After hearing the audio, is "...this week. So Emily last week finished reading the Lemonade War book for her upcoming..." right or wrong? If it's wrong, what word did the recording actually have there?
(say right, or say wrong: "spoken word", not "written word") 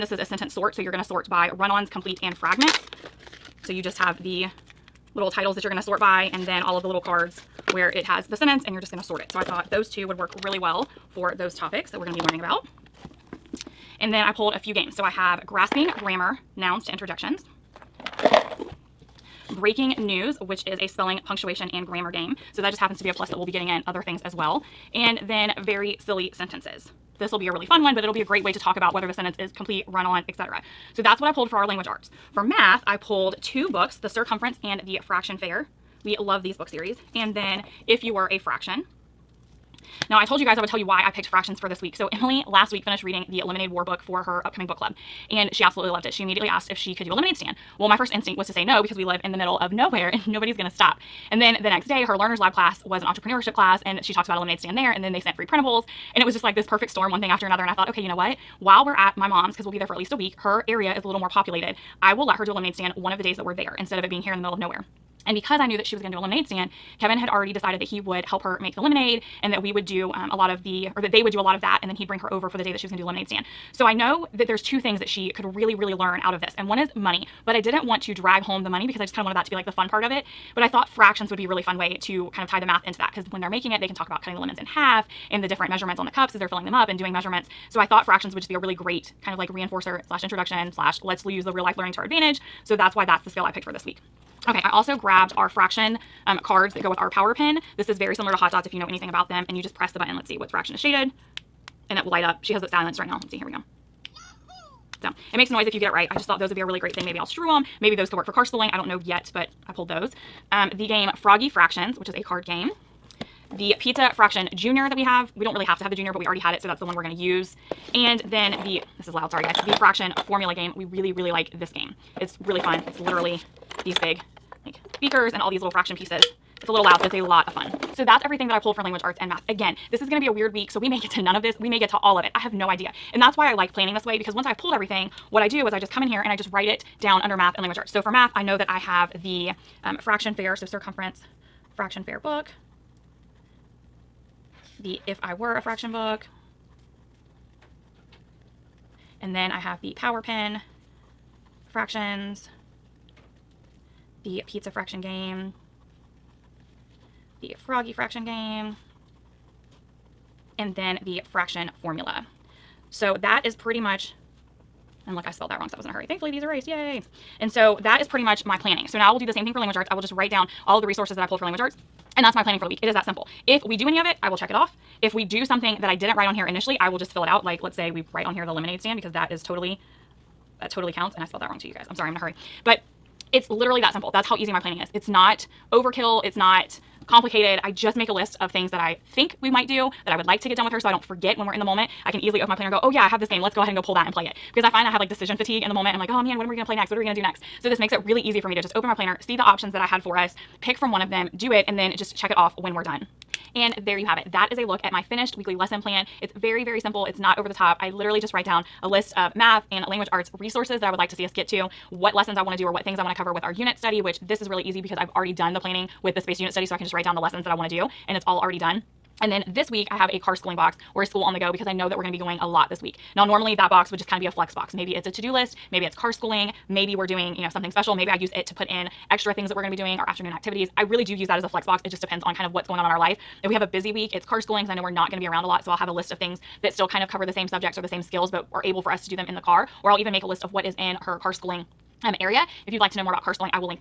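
right.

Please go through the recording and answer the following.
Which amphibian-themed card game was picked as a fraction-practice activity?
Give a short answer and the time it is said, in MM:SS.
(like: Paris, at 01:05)
Froggy Fractions, at 01:51.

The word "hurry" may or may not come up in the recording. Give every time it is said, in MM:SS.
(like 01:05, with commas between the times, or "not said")
02:45, 03:02.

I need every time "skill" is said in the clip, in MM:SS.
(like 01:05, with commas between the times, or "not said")
01:33, 03:58.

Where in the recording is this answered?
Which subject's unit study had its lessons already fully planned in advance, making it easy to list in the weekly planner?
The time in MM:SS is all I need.
03:36.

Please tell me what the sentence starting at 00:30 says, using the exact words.
So that's what I pulled for our language arts.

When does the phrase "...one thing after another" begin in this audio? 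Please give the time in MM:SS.
00:57.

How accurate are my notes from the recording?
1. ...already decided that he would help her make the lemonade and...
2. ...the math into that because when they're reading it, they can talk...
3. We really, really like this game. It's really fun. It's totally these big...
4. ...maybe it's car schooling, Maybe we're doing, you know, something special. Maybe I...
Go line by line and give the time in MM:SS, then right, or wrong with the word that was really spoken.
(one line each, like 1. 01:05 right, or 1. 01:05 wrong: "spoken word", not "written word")
1. 01:07 right
2. 01:22 wrong: "making", not "reading"
3. 02:00 wrong: "literally", not "totally"
4. 03:45 right.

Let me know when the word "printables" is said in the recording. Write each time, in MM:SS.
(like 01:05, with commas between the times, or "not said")
00:55.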